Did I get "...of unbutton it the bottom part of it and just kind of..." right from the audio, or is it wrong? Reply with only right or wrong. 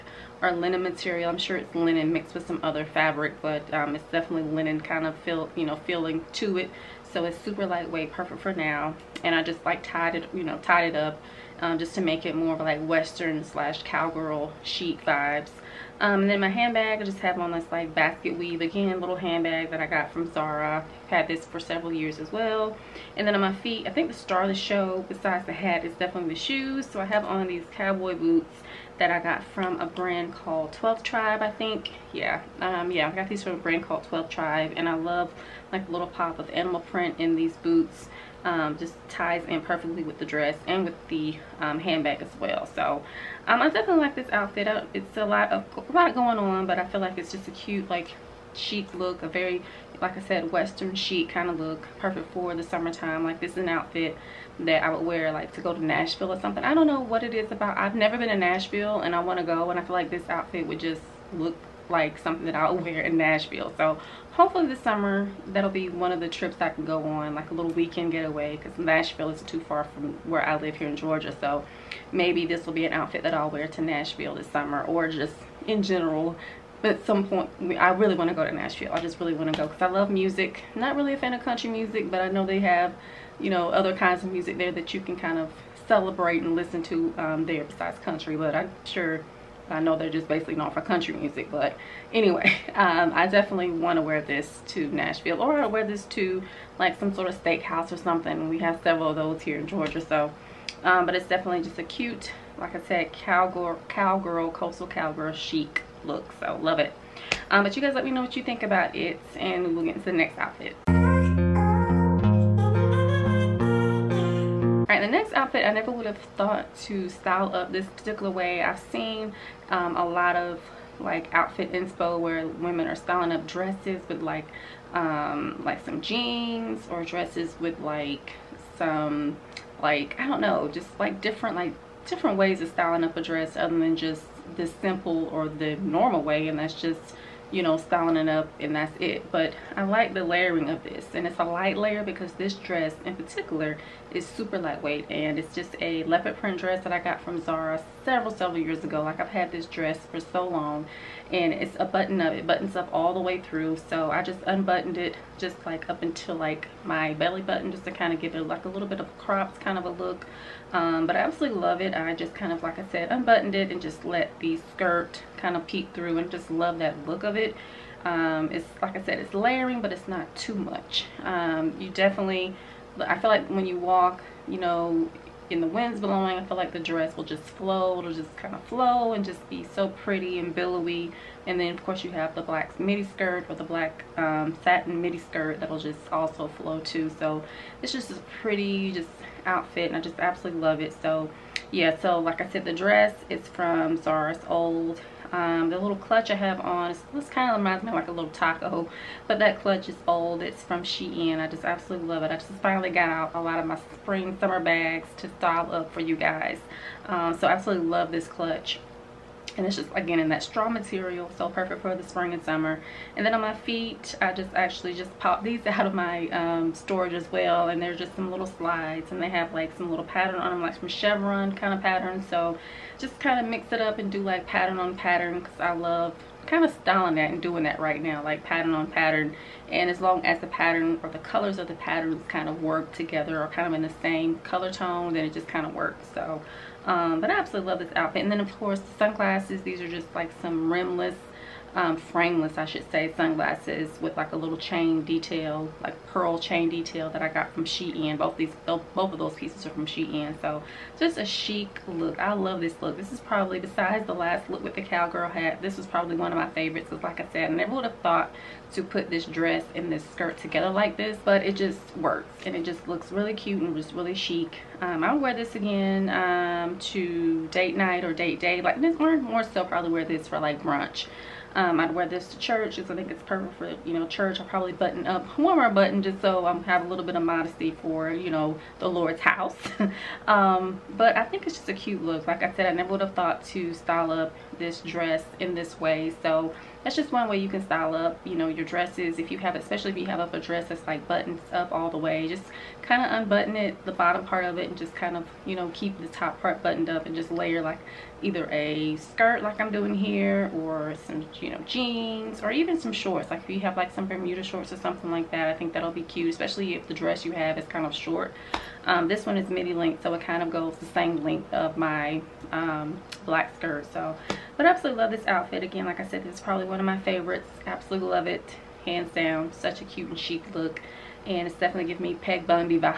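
right.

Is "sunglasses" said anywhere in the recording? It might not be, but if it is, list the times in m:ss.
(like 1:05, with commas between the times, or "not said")
3:58, 4:03.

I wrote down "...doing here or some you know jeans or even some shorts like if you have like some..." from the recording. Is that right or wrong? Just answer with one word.
right.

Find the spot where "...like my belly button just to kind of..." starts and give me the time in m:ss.
2:36.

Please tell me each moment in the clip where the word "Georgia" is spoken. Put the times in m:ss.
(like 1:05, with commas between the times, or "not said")
1:10, 1:39.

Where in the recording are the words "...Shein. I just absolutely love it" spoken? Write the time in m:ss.
3:20.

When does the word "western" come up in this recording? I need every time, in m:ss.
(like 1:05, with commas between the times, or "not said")
0:12, 0:50.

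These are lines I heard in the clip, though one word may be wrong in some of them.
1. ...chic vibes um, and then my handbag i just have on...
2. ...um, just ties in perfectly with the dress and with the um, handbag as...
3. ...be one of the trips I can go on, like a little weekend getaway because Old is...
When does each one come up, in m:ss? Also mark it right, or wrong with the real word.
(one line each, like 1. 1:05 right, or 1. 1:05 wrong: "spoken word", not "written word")
1. 0:14 right
2. 0:38 right
3. 1:05 wrong: "Nashville", not "Old".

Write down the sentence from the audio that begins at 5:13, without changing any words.
So, but I absolutely love this outfit.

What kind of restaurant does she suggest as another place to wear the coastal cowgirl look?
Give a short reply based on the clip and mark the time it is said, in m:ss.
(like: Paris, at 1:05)
Steakhouse, at 1:37.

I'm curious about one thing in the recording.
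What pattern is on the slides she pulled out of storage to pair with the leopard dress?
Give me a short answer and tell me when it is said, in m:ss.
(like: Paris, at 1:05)
Chevron, at 3:40.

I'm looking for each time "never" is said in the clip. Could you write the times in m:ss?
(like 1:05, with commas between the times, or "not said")
0:57, 1:55, 4:17, 4:42.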